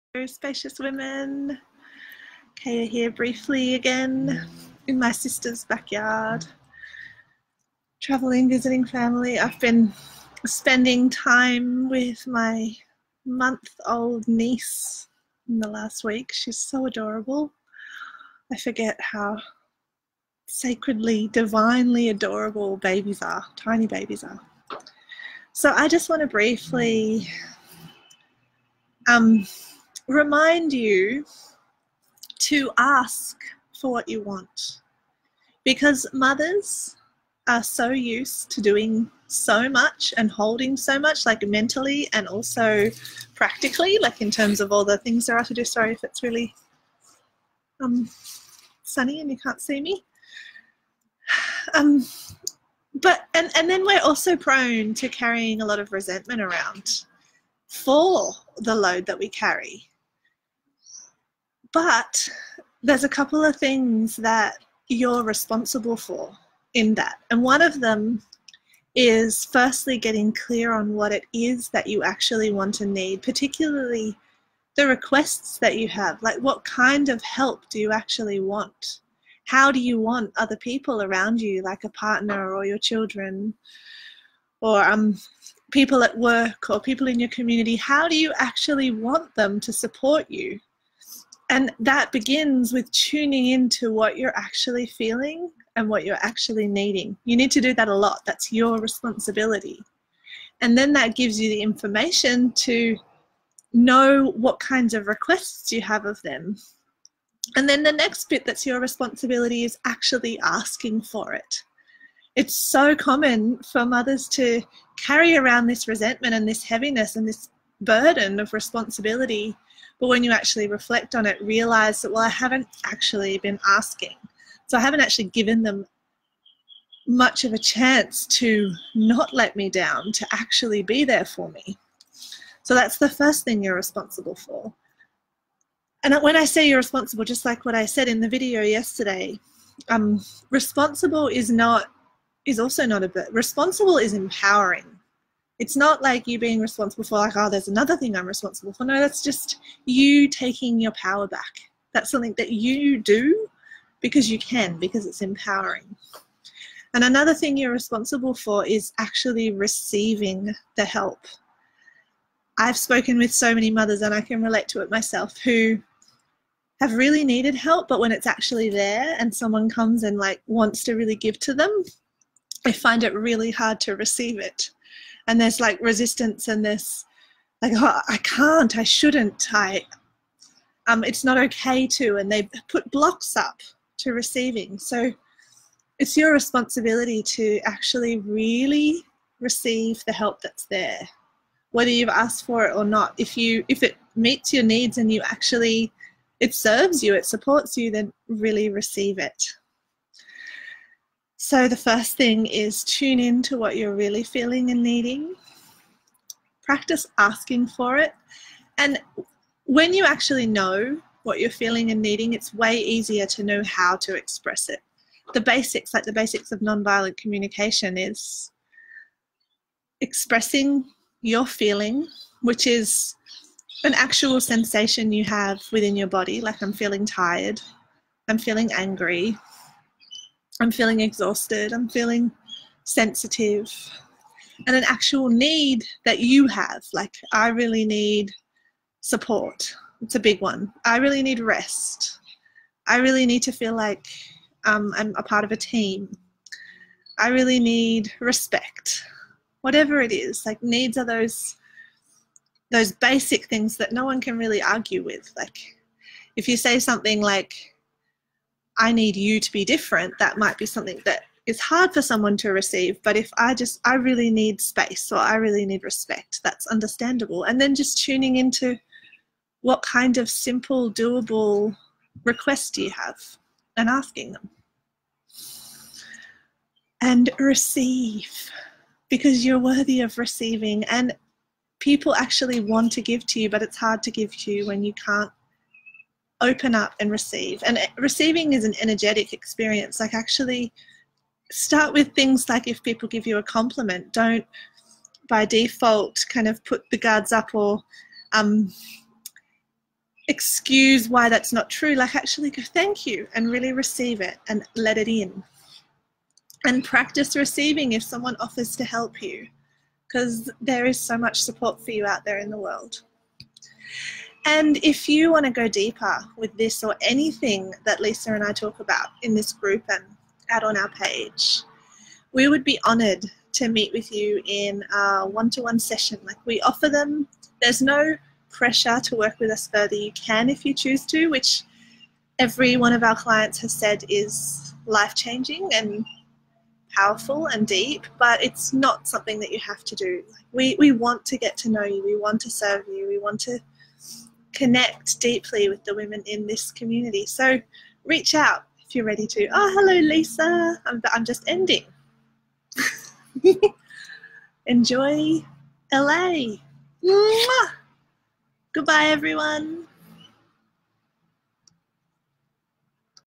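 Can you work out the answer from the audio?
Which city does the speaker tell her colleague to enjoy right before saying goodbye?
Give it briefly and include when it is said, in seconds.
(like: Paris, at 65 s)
LA, at 355 s.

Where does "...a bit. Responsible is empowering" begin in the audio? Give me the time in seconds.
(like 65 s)
143 s.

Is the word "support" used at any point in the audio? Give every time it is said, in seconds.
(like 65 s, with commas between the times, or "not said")
89 s, 197 s, 239 s, 311 s.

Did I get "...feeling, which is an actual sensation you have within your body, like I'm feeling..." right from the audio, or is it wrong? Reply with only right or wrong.
right.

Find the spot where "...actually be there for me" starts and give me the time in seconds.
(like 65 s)
130 s.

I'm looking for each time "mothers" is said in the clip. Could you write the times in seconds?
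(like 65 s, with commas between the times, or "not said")
36 s, 113 s, 163 s.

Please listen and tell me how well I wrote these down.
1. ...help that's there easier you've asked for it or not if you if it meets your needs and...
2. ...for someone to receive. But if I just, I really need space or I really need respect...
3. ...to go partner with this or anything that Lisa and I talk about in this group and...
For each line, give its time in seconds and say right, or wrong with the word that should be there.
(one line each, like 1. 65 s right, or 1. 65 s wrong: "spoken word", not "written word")
1. 190 s wrong: "whether", not "easier"
2. 261 s right
3. 315 s wrong: "deeper", not "partner".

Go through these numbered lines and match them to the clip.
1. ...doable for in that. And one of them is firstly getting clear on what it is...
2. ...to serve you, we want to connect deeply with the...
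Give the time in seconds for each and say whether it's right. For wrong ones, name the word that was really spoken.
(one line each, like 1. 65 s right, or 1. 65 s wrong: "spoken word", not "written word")
1. 65 s wrong: "responsible", not "doable"
2. 342 s right.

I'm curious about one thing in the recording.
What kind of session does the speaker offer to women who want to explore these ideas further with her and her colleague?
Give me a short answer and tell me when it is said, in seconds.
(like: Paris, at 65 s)
One to one session, at 325 s.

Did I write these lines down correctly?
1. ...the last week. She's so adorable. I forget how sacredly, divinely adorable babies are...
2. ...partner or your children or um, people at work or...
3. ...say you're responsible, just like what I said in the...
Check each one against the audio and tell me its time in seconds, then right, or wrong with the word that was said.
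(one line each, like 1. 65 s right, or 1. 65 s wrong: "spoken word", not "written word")
1. 15 s right
2. 81 s right
3. 136 s right.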